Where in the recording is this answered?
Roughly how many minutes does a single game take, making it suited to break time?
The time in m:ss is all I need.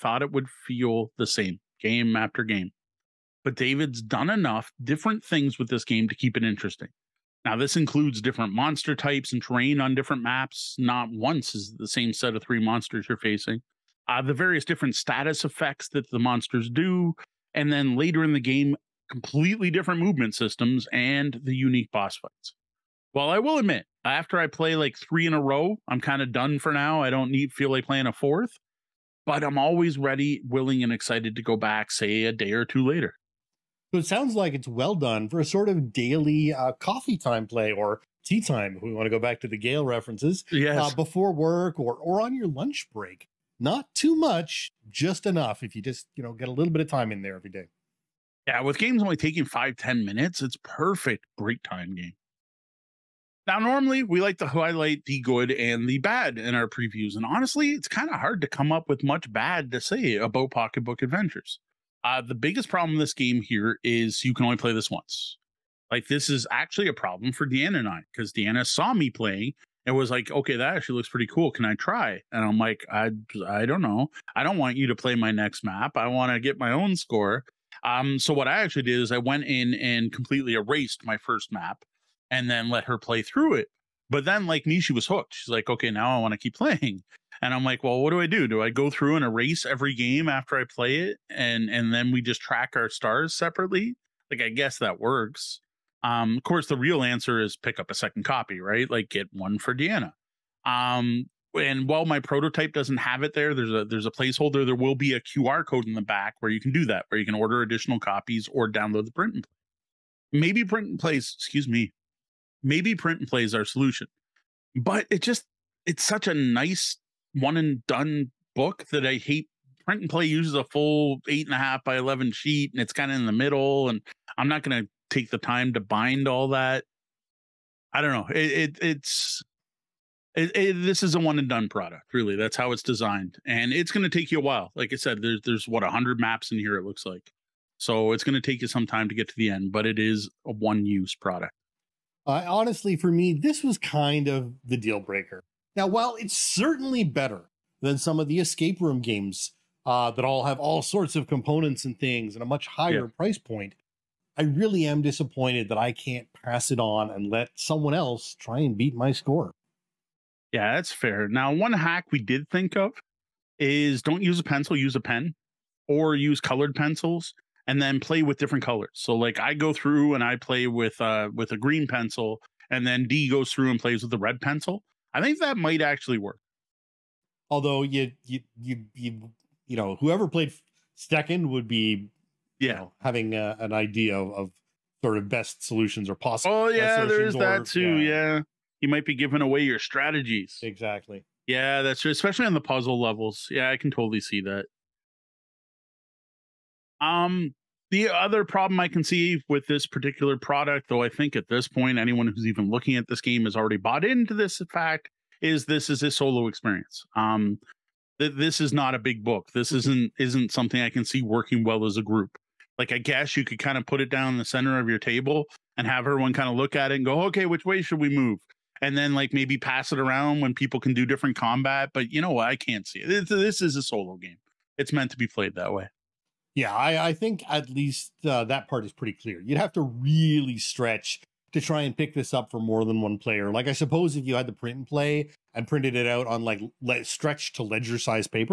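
0:49.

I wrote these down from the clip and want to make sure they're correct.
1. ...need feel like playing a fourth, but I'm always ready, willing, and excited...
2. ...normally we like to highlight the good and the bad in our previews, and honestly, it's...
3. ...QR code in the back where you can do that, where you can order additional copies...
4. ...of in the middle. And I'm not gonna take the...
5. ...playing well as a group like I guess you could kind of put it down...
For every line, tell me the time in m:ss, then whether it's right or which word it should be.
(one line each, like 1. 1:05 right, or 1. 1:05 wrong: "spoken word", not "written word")
1. 0:27 right
2. 0:53 right
3. 1:45 right
4. 2:03 right
5. 3:31 wrong: "working", not "playing".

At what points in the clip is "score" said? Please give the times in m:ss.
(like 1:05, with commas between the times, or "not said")
1:16, 2:39.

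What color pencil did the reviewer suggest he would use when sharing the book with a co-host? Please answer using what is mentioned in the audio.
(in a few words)
green.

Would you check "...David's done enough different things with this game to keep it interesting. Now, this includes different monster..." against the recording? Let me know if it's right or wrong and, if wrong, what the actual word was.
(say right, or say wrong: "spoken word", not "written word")
right.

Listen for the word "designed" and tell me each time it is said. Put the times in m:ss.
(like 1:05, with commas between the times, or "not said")
2:12.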